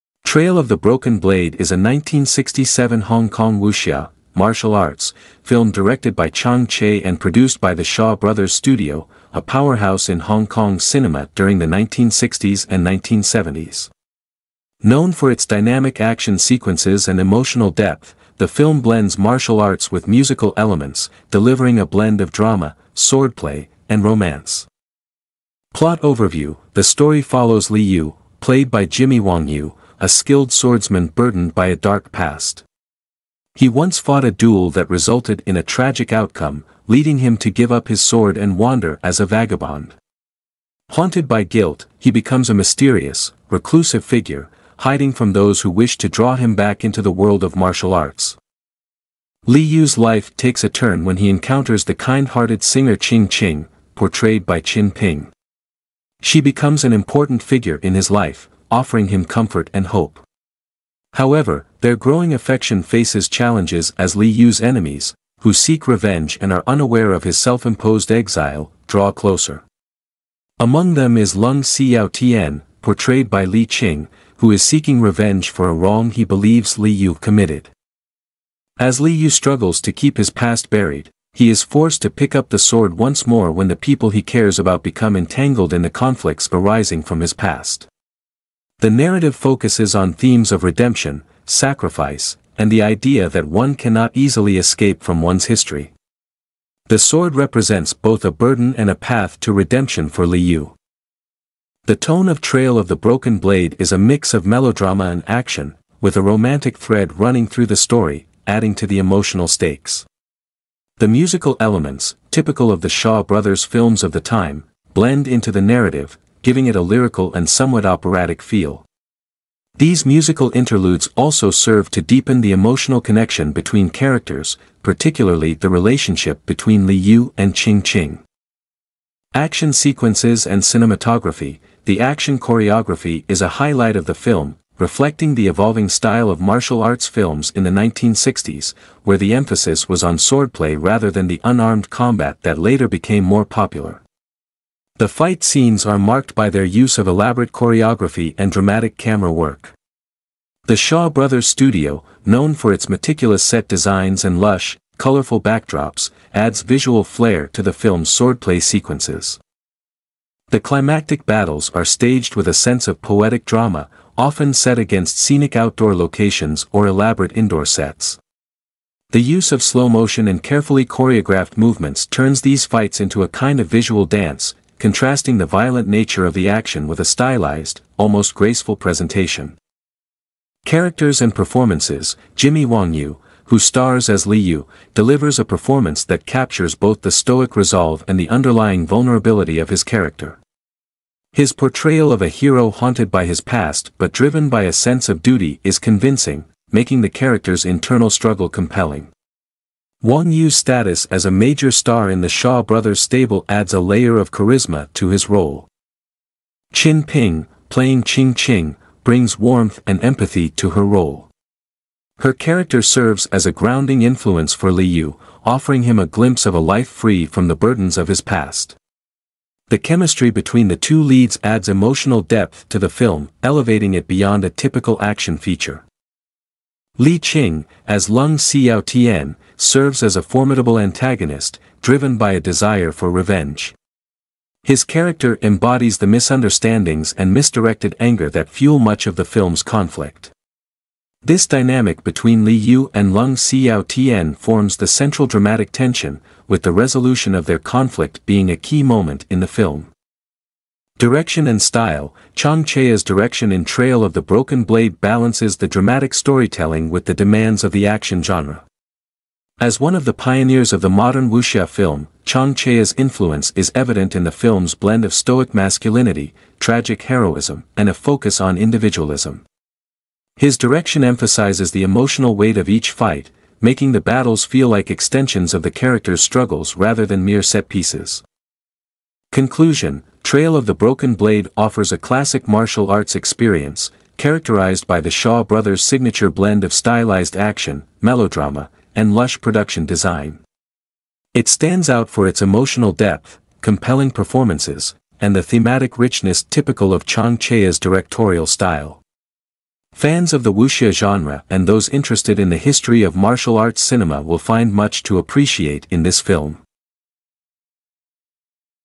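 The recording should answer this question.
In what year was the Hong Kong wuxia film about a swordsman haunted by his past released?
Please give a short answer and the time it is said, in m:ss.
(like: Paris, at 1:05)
1967, at 0:01.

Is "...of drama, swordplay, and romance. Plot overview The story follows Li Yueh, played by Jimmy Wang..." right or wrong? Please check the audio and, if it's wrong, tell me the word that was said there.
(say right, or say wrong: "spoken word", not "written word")
right.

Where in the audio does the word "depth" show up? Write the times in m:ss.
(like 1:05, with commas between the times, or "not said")
0:17, 3:42, 4:52.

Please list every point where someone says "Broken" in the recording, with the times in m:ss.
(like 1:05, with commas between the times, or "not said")
0:00, 1:42, 4:14, 4:40.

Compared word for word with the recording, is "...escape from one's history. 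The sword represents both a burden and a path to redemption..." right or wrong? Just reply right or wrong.
right.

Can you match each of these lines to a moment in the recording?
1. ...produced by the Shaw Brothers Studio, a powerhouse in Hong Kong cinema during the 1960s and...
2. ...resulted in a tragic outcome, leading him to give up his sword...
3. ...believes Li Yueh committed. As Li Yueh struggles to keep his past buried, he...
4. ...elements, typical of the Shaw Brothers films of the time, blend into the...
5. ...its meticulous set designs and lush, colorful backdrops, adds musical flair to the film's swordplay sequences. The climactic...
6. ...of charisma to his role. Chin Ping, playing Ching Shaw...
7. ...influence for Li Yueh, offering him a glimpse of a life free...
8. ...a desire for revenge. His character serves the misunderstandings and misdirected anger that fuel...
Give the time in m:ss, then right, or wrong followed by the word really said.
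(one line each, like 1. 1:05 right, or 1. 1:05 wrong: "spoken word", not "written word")
1. 0:07 right
2. 0:34 right
3. 1:16 right
4. 1:51 right
5. 2:32 wrong: "visual", not "musical"
6. 3:24 wrong: "Ching", not "Shaw"
7. 3:34 right
8. 3:52 wrong: "embodies", not "serves".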